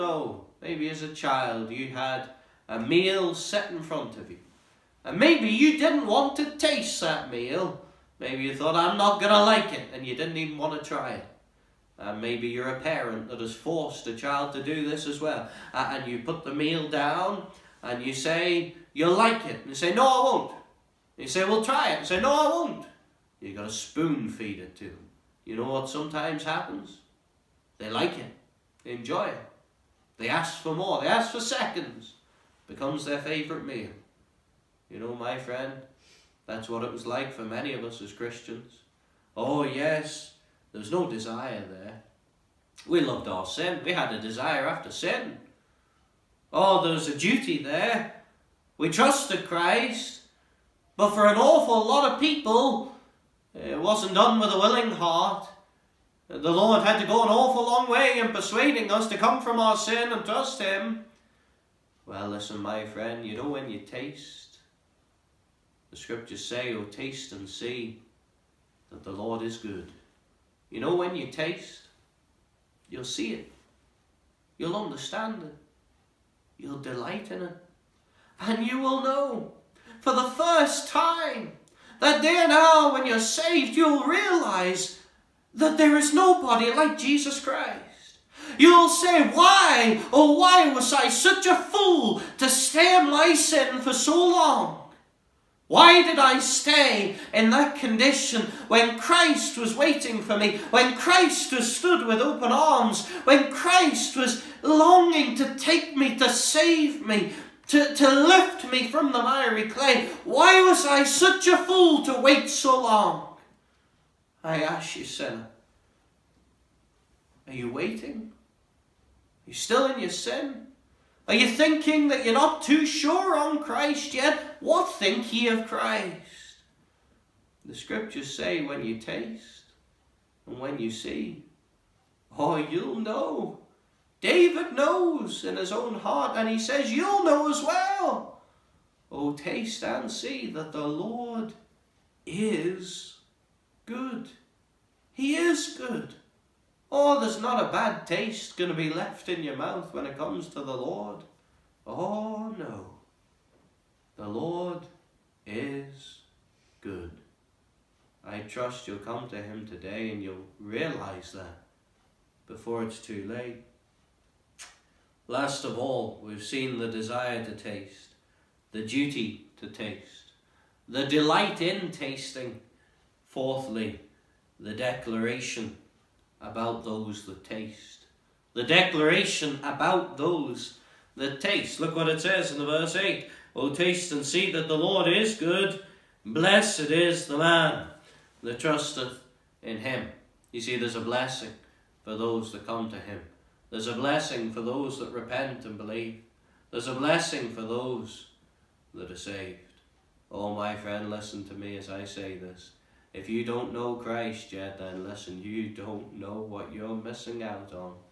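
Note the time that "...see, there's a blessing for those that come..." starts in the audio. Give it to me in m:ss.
3:10.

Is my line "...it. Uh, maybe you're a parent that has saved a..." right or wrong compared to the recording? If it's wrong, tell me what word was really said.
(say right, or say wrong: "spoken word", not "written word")
wrong: "forced", not "saved".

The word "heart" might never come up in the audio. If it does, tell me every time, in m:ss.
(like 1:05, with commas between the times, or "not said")
0:54, 2:16.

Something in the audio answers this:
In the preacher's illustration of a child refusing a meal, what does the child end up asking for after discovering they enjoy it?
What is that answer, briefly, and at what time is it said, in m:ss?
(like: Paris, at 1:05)
seconds, at 0:31.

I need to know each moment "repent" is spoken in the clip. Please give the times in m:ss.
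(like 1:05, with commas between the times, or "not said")
3:15.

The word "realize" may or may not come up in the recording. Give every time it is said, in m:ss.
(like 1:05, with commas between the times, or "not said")
1:24, 2:40.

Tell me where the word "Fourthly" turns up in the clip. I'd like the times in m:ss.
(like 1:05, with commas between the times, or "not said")
2:53.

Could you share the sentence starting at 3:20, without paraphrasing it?
Oh, my friend, listen to me as I say this.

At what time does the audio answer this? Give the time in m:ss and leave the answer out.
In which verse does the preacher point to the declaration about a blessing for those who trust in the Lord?
3:02.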